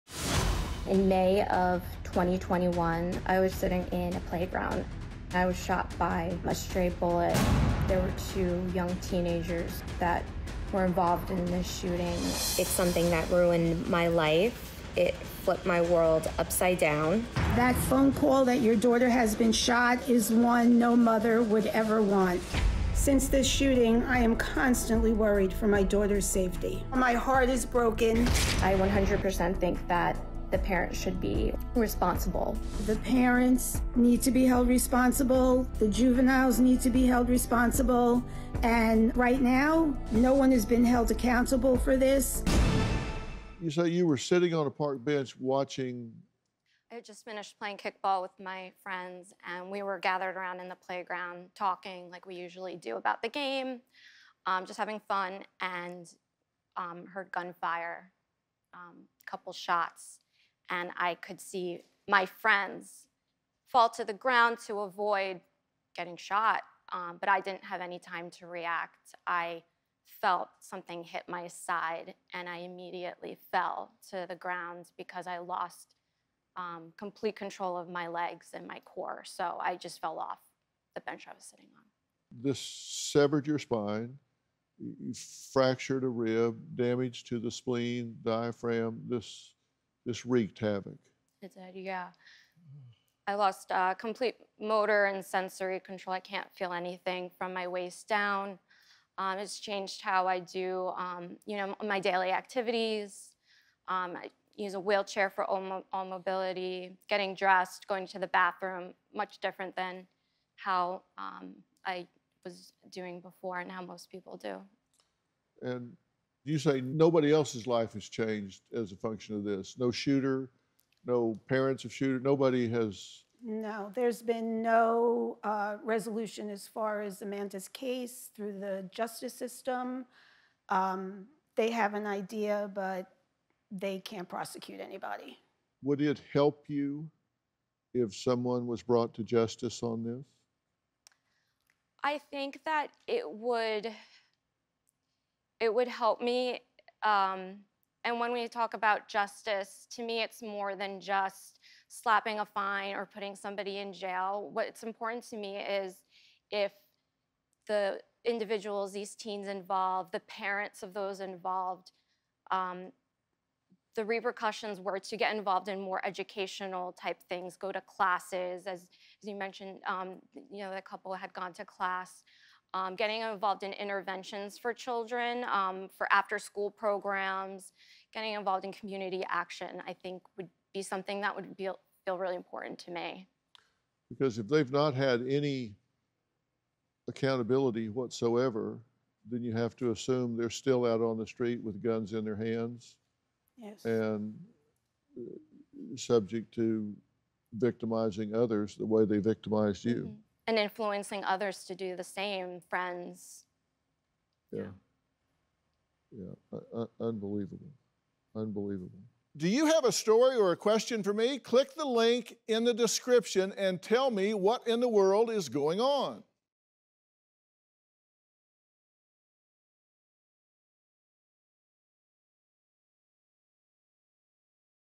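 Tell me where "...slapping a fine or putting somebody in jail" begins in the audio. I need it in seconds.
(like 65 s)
151 s.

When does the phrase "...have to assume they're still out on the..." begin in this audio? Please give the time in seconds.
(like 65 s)
189 s.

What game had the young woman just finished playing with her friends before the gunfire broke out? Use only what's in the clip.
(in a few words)
Kickball.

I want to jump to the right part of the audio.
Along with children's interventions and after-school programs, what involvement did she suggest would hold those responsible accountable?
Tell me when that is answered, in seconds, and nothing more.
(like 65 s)
178 s.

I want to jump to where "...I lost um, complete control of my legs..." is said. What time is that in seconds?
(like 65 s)
75 s.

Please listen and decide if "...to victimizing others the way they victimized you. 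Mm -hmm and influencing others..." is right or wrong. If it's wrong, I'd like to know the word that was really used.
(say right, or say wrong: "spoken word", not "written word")
right.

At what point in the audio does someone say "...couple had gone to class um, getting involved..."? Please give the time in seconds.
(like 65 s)
170 s.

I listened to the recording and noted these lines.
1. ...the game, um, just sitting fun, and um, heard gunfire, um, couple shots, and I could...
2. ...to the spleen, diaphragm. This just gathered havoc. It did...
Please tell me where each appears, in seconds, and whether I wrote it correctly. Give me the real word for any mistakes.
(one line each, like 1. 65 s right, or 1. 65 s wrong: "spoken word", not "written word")
1. 53 s wrong: "having", not "sitting"
2. 87 s wrong: "wreaked", not "gathered".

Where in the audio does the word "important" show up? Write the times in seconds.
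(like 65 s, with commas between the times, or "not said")
154 s, 182 s.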